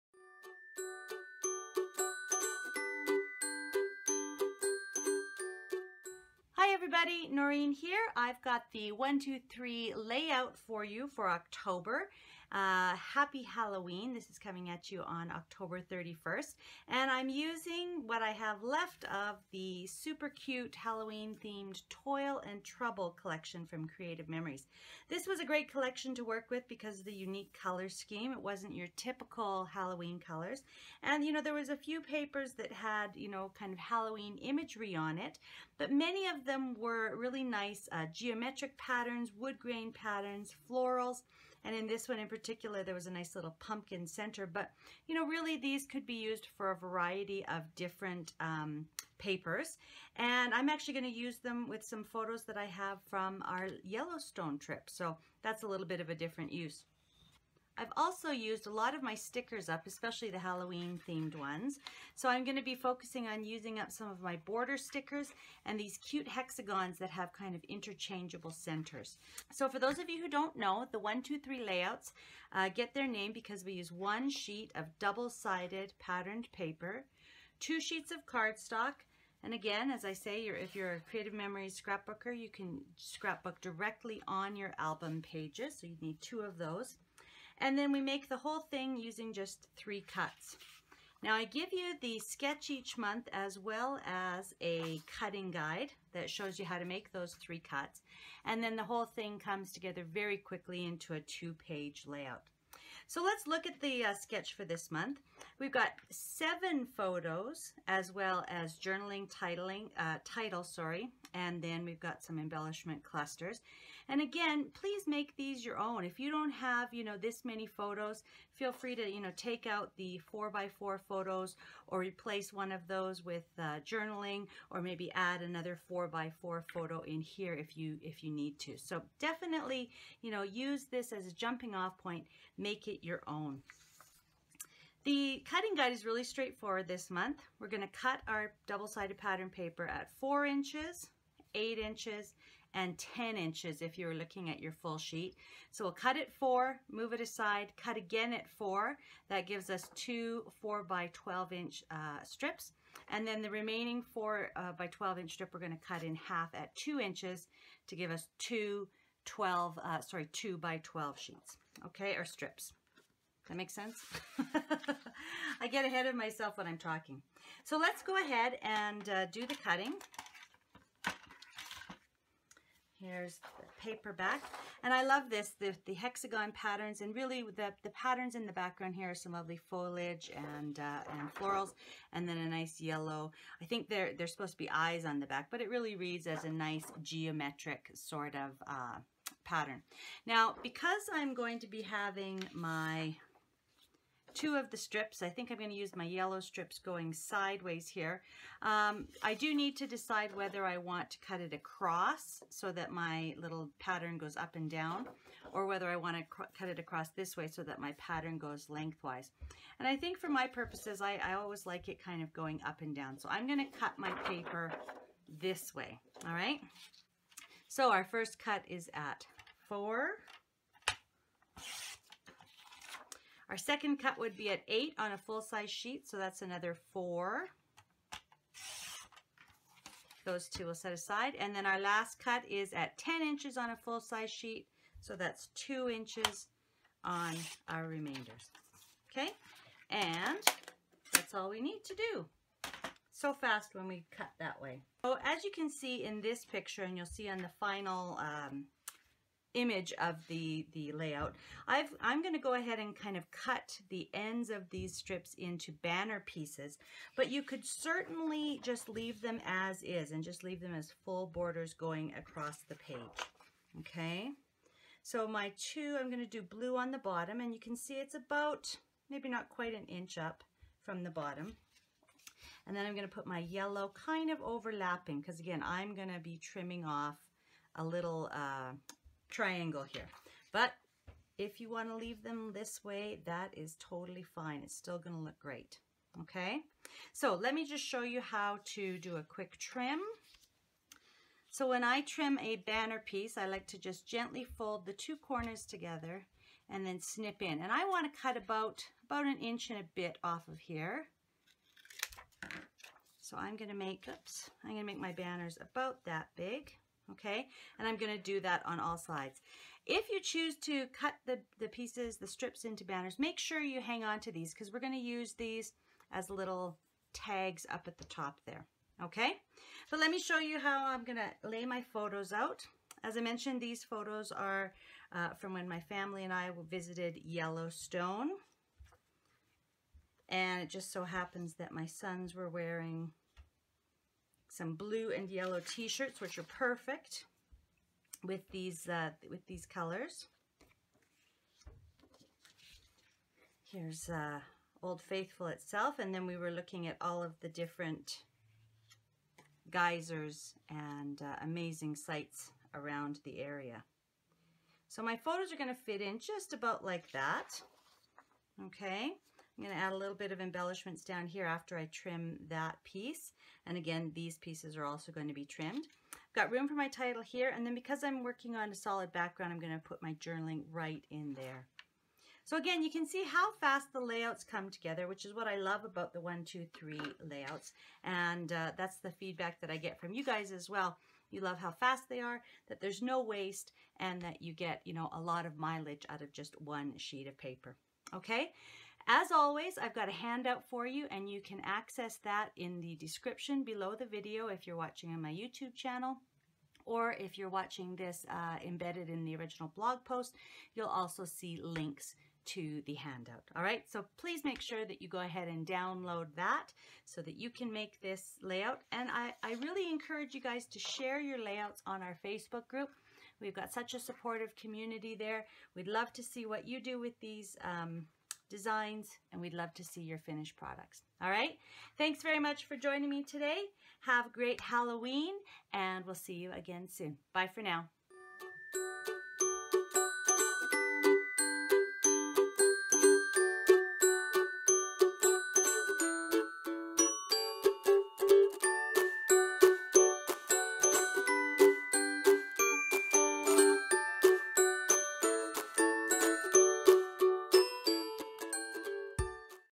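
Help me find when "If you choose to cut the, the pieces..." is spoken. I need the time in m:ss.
5:09.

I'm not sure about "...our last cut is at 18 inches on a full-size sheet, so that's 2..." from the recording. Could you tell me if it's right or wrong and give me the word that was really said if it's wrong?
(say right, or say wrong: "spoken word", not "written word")
wrong: "10", not "18".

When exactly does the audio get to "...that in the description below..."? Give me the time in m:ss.
6:32.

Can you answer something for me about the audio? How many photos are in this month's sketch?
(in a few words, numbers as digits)
7.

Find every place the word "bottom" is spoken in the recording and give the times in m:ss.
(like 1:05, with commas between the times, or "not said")
4:26, 4:31.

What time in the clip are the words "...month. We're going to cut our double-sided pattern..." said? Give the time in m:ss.
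2:17.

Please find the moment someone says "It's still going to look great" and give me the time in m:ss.
4:44.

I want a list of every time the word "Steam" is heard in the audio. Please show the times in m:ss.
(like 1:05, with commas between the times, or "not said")
not said.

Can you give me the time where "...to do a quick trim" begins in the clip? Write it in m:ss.
4:48.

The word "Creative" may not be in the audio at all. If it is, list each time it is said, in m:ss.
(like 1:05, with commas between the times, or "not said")
0:23, 1:21.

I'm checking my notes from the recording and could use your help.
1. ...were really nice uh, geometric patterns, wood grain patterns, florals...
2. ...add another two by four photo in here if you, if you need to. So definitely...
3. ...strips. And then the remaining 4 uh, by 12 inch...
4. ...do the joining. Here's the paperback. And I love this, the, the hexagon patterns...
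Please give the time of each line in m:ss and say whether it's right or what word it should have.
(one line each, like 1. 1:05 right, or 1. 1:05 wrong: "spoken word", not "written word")
1. 0:36 right
2. 2:05 wrong: "four", not "two"
3. 2:32 right
4. 2:49 wrong: "cutting", not "joining".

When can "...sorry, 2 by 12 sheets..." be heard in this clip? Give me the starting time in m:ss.
2:40.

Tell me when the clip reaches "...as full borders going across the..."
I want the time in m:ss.
4:20.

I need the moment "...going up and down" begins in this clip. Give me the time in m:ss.
3:32.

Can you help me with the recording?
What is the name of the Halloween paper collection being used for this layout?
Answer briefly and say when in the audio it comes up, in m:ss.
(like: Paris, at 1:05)
Toil and Trouble, at 0:21.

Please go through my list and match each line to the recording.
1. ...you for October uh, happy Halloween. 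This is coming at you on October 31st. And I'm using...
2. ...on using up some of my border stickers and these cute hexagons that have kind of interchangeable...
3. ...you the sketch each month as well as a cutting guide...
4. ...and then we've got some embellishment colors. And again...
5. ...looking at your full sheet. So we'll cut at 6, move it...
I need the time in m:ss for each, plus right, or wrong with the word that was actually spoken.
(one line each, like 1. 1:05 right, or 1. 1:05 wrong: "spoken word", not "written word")
1. 0:10 right
2. 1:03 right
3. 1:31 right
4. 1:51 wrong: "clusters", not "colors"
5. 2:24 wrong: "4", not "6".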